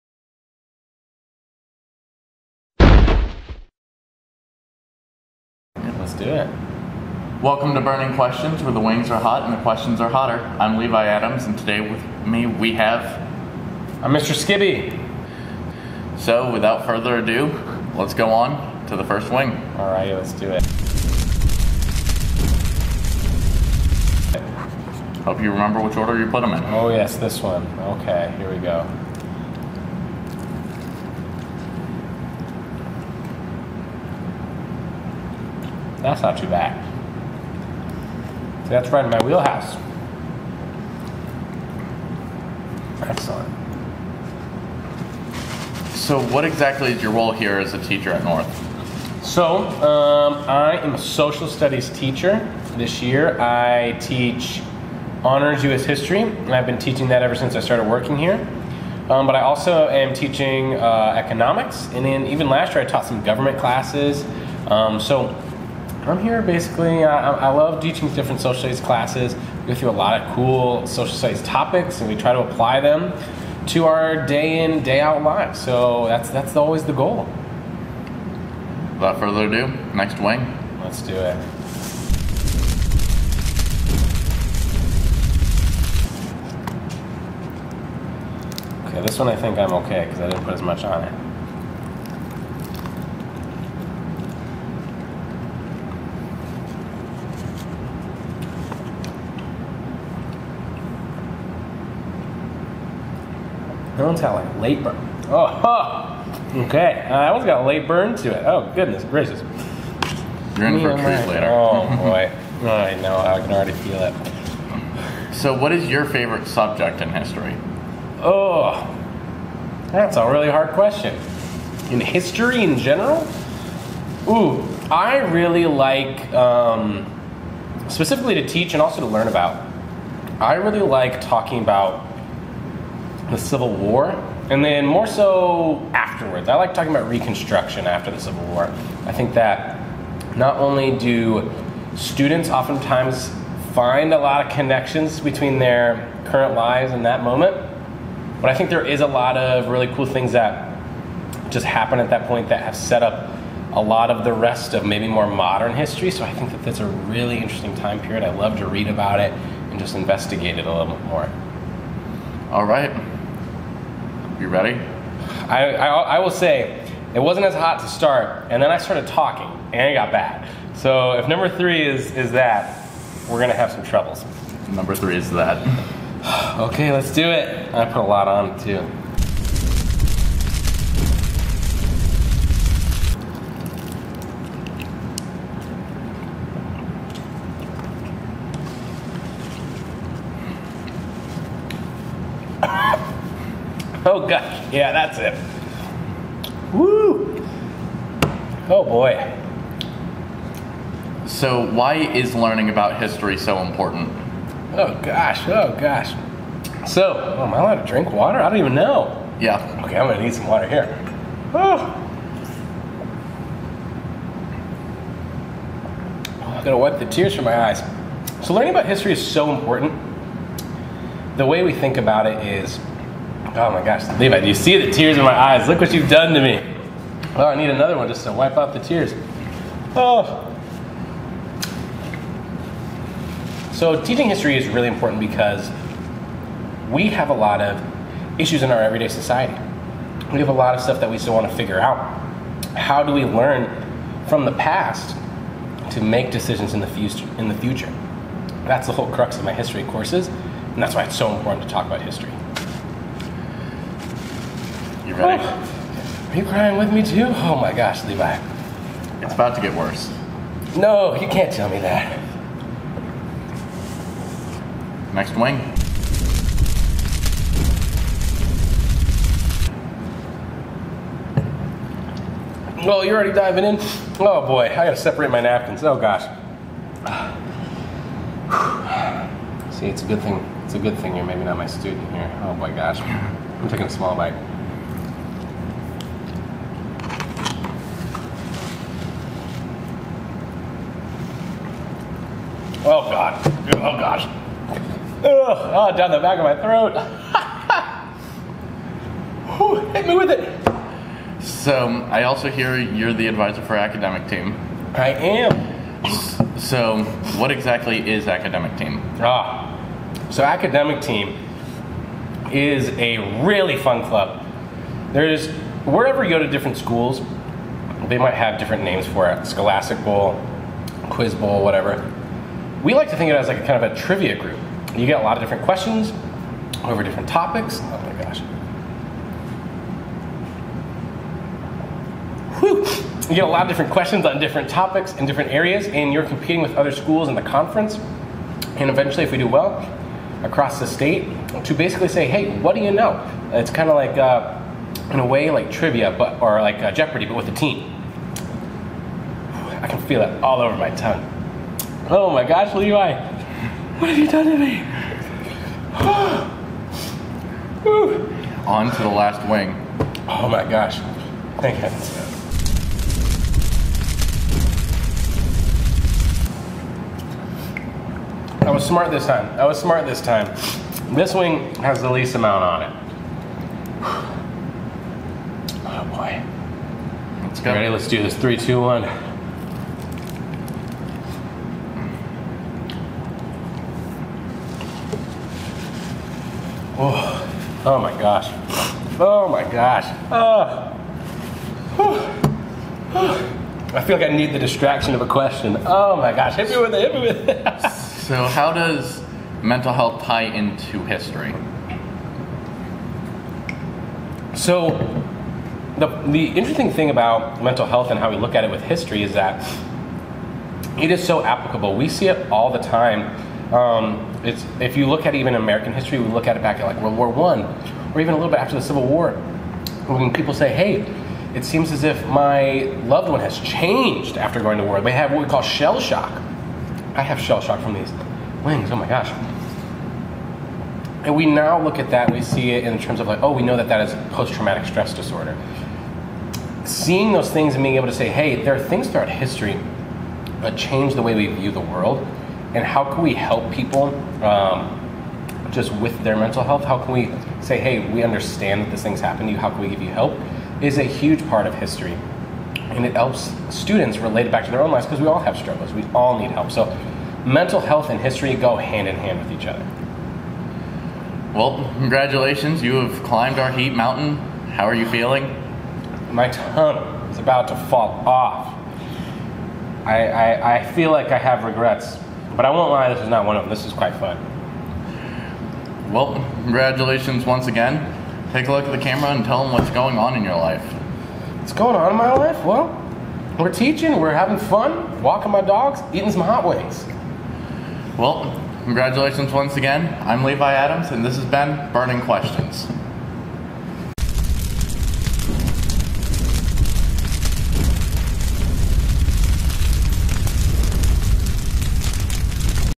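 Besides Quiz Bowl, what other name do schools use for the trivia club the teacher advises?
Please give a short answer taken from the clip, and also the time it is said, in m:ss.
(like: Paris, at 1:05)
Scholastic Bowl, at 5:19.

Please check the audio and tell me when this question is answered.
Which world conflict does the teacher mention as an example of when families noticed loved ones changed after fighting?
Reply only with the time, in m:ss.
6:57.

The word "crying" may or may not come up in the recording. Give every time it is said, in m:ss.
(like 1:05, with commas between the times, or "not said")
4:16.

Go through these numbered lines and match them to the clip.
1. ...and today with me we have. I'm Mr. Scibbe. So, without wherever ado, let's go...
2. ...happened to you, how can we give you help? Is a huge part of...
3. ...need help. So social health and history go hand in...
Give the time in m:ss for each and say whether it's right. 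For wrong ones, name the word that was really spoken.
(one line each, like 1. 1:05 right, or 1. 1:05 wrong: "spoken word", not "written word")
1. 0:11 wrong: "further", not "wherever"
2. 7:29 right
3. 7:36 wrong: "mental", not "social".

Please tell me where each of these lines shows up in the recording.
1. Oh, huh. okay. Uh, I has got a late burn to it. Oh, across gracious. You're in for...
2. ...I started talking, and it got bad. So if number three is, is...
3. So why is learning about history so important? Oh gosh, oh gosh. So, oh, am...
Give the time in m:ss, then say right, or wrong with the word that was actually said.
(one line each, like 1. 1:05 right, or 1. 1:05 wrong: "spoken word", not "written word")
1. 1:45 wrong: "goodness", not "across"
2. 2:48 right
3. 3:21 right.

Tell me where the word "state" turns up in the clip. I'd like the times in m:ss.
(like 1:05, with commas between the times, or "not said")
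5:40.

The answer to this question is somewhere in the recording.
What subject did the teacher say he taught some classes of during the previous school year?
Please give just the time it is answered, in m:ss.
1:03.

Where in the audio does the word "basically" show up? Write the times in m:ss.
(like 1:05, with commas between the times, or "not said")
1:06, 5:41.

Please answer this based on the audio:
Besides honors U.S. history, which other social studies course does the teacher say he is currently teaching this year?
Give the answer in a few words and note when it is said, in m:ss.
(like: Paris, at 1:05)
Economics, at 1:01.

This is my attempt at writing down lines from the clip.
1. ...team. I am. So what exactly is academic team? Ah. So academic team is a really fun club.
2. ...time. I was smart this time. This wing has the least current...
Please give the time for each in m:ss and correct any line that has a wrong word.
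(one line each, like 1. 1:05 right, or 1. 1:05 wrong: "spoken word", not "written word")
1. 5:04 right
2. 6:09 wrong: "amount", not "current".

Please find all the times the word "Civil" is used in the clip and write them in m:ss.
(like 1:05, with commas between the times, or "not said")
2:13, 2:18, 6:58.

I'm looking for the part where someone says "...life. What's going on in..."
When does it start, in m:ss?
8:00.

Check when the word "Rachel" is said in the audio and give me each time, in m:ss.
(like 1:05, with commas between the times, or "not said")
not said.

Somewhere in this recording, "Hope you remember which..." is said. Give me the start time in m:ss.
0:25.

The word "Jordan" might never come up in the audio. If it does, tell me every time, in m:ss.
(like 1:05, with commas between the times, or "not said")
not said.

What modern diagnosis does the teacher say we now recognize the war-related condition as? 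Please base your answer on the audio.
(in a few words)
Post-traumatic stress disorder.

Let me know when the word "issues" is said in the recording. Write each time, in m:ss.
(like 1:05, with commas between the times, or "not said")
3:58.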